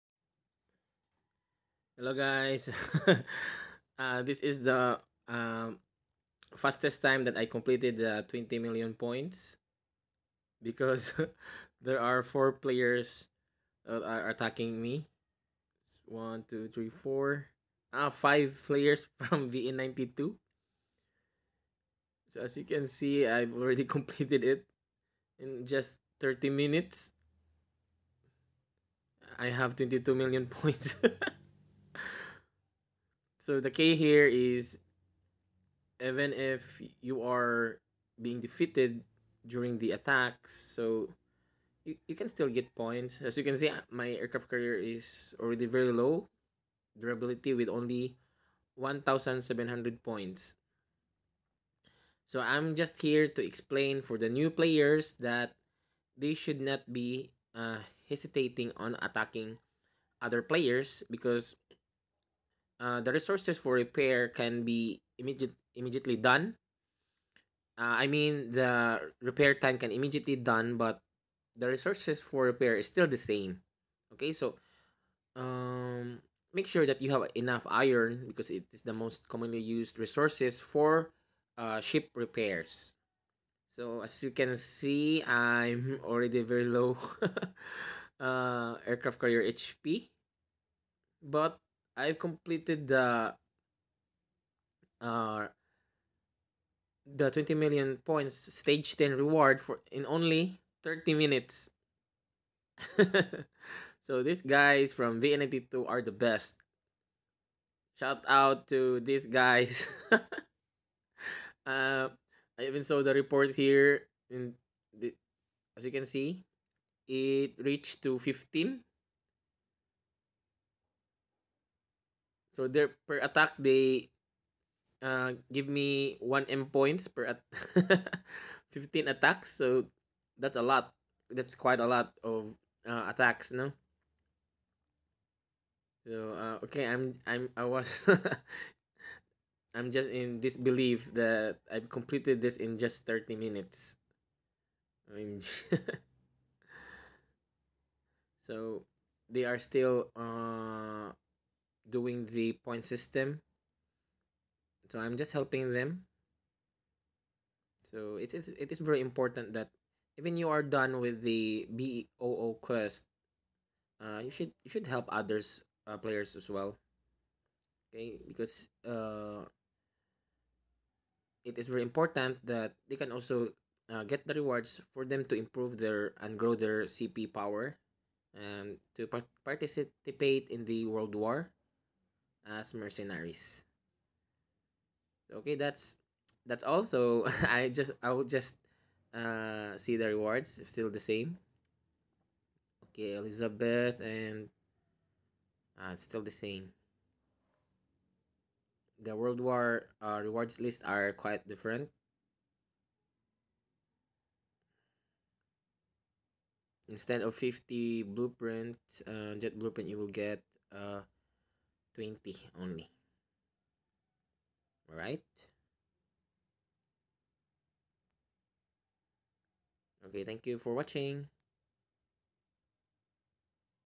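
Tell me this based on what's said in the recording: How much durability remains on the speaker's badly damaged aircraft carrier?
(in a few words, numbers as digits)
1,700.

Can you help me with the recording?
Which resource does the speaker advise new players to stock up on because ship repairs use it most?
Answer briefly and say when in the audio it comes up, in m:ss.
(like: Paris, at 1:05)
Iron, at 1:17.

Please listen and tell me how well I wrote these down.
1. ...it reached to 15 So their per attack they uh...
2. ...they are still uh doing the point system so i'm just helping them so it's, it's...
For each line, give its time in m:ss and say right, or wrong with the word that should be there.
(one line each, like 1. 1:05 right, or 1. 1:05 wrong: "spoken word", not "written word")
1. 1:57 right
2. 2:29 right.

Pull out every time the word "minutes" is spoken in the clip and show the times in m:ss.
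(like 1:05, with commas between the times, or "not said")
0:26, 1:41, 2:23.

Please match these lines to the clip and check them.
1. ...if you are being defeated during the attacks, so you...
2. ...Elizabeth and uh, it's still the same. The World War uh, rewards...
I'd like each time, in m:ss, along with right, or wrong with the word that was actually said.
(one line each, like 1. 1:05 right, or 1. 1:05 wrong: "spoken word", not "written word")
1. 0:36 right
2. 3:13 right.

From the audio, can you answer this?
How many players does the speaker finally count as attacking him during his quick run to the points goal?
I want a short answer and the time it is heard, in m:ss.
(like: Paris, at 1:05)
5, at 0:18.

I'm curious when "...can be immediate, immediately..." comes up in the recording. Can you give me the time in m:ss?
1:04.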